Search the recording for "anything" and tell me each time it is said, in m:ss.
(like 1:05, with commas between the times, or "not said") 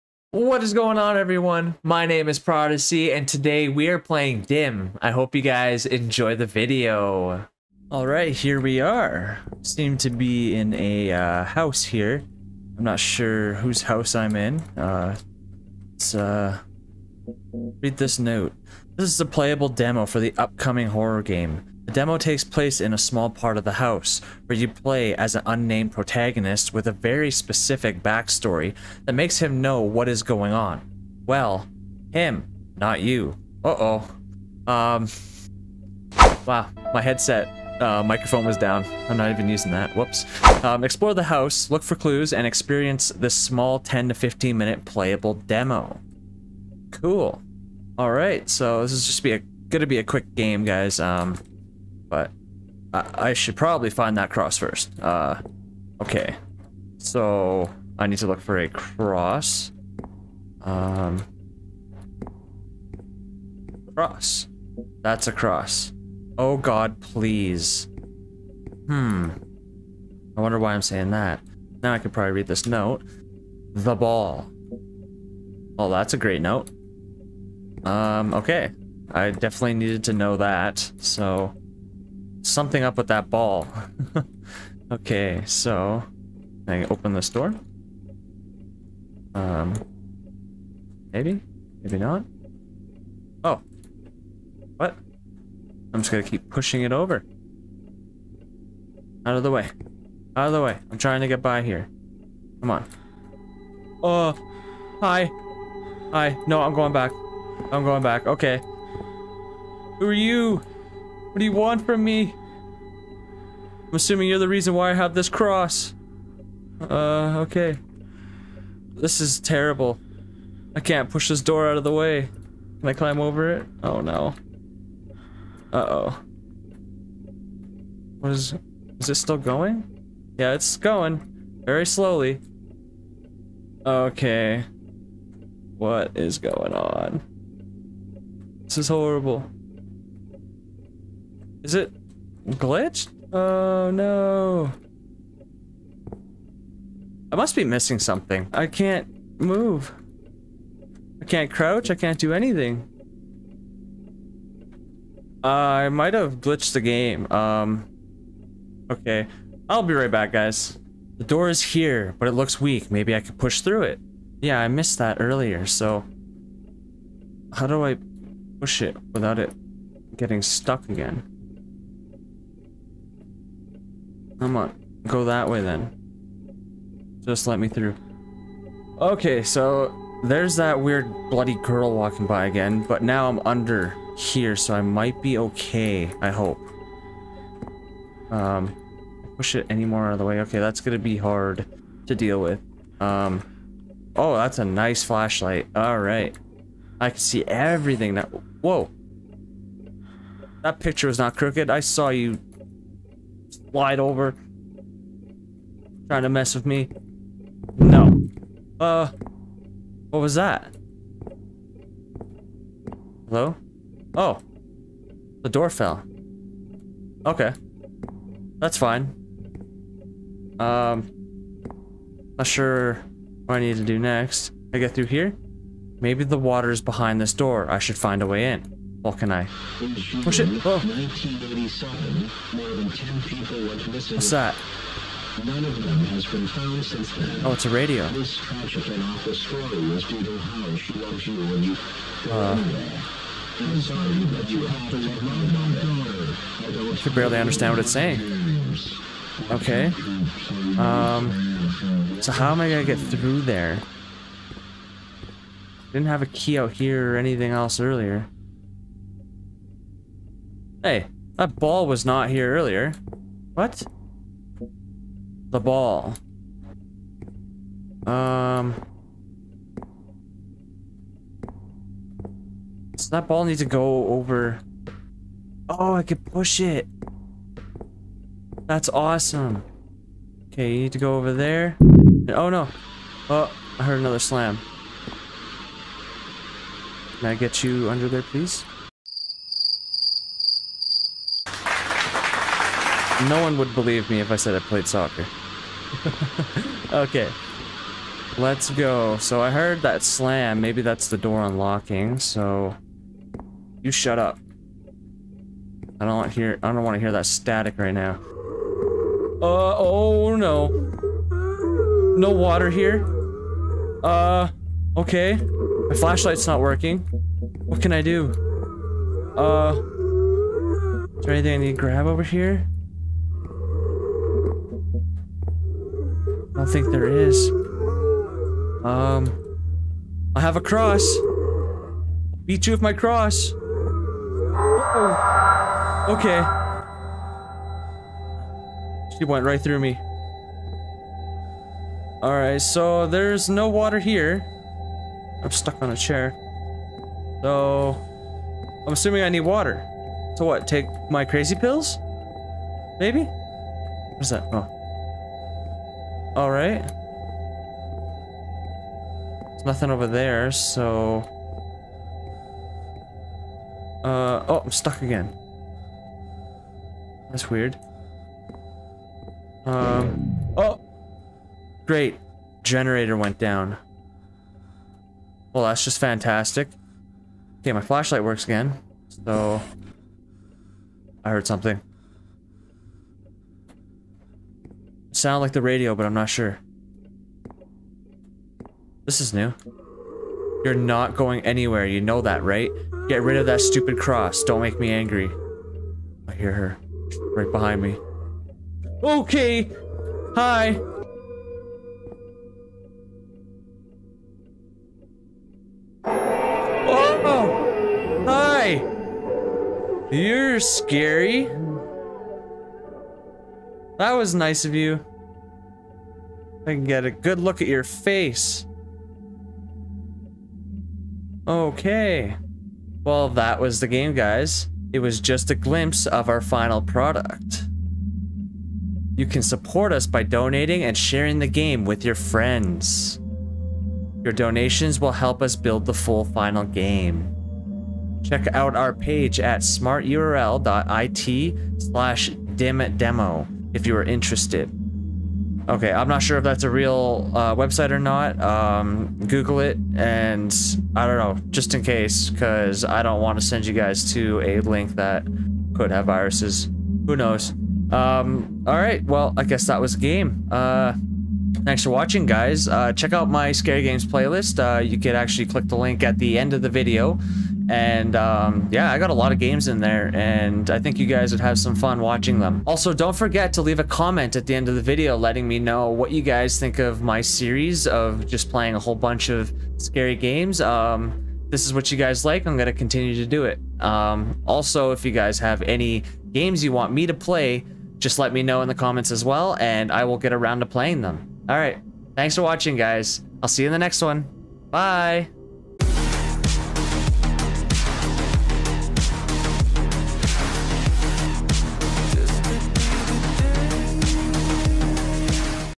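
2:32, 4:17, 5:21.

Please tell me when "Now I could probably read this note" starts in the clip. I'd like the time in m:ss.
1:11.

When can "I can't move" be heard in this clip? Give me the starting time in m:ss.
2:28.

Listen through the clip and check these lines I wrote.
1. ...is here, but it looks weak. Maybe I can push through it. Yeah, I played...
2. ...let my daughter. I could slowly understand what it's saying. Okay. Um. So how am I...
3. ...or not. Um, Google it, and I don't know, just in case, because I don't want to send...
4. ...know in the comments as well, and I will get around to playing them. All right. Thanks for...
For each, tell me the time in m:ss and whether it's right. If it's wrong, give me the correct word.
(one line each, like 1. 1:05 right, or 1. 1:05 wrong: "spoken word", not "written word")
1. 2:41 wrong: "missed", not "played"
2. 4:04 wrong: "barely", not "slowly"
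3. 7:27 right
4. 8:08 right.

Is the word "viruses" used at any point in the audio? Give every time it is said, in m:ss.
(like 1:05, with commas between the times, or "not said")
7:36.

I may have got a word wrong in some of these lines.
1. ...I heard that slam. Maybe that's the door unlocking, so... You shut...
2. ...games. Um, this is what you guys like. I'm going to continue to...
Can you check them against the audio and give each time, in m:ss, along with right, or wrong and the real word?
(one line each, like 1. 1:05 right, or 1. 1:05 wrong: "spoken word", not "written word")
1. 4:59 right
2. 8:00 right.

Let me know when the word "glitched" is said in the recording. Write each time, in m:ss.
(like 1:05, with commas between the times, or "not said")
2:22, 2:36.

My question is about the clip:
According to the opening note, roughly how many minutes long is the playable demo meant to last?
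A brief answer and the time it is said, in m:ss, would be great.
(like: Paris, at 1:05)
10 to 15 minutes, at 0:43.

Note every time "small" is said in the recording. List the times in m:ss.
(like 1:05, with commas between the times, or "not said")
0:22, 0:43.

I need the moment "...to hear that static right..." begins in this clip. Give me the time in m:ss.
5:06.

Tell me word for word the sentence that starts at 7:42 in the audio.
Uh, check out my Scary Games playlist.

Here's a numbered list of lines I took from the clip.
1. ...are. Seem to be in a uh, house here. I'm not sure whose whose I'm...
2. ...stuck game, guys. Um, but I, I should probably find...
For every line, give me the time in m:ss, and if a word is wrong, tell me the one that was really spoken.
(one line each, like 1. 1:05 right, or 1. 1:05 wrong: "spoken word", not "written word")
1. 0:08 wrong: "house", not "whose"
2. 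0:50 wrong: "quick", not "stuck".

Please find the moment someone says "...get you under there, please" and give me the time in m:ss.
4:47.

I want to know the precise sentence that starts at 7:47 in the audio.
And um, yeah, I got a lot of games in there and I think you guys would have some fun watching them.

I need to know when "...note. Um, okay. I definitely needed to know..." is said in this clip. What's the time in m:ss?
1:16.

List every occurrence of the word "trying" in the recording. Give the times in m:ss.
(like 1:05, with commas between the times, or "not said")
1:40, 3:26.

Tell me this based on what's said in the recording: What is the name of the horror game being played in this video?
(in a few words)
Dim.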